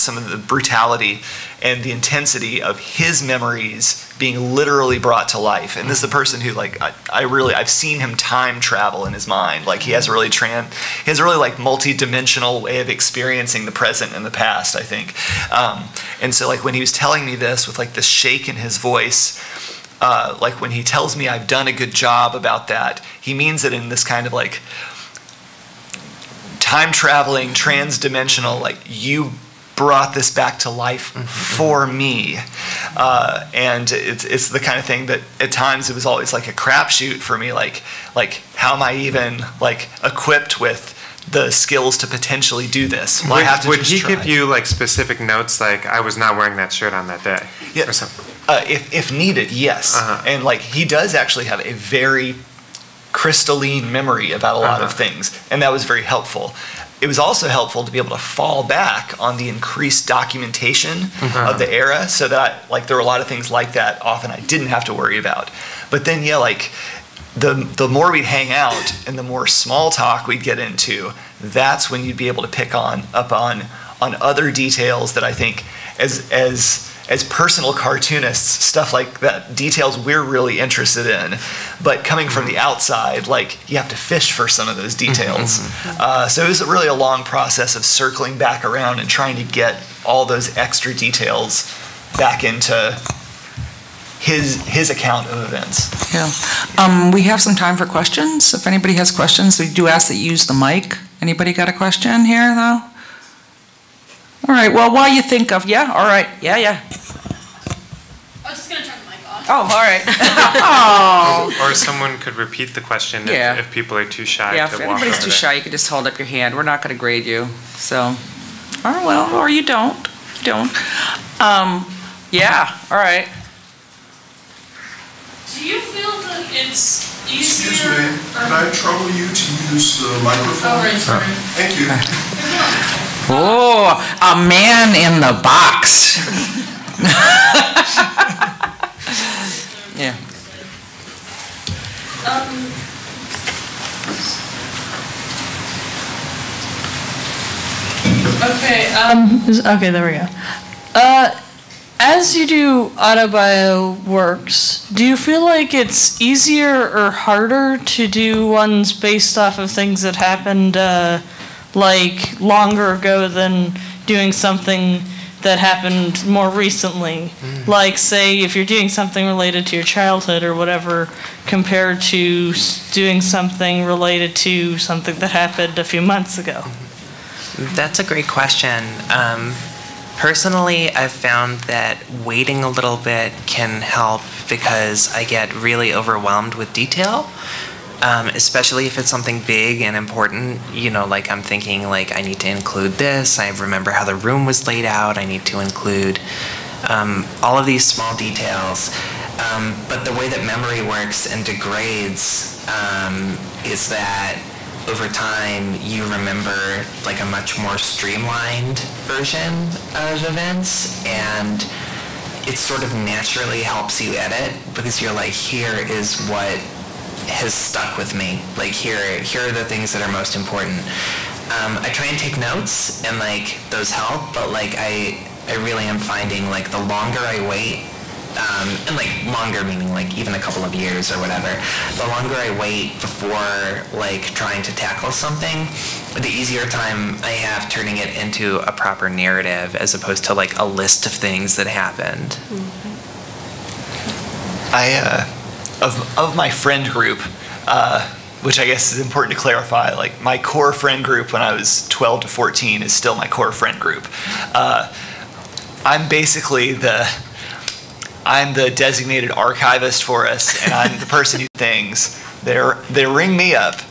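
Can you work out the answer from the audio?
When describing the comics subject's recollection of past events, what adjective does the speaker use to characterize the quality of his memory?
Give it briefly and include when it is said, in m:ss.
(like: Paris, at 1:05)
crystalline, at 0:53.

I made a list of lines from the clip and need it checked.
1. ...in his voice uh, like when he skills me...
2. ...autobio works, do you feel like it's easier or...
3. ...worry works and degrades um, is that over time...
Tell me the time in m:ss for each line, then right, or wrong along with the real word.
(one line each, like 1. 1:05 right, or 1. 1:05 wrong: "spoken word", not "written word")
1. 0:18 wrong: "tells", not "skills"
2. 2:32 right
3. 3:20 wrong: "memory", not "worry".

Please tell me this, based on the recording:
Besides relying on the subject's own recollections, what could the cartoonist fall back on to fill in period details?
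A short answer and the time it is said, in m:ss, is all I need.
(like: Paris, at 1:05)
increased documentation, at 0:59.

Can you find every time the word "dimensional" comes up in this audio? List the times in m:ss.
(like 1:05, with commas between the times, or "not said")
0:11, 0:27.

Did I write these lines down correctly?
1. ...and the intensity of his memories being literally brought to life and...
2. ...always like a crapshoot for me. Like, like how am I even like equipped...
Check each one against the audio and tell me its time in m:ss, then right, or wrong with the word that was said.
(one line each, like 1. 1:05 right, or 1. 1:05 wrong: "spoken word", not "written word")
1. 0:01 right
2. 0:36 right.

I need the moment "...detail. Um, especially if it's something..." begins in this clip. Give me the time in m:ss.
3:06.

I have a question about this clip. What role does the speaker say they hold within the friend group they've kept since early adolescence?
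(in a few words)
designated archivist.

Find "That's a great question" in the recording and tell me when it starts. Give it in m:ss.
2:57.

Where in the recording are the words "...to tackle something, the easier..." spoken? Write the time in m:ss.
3:54.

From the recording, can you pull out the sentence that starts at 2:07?
Excuse me, can I trouble you to use the microphone?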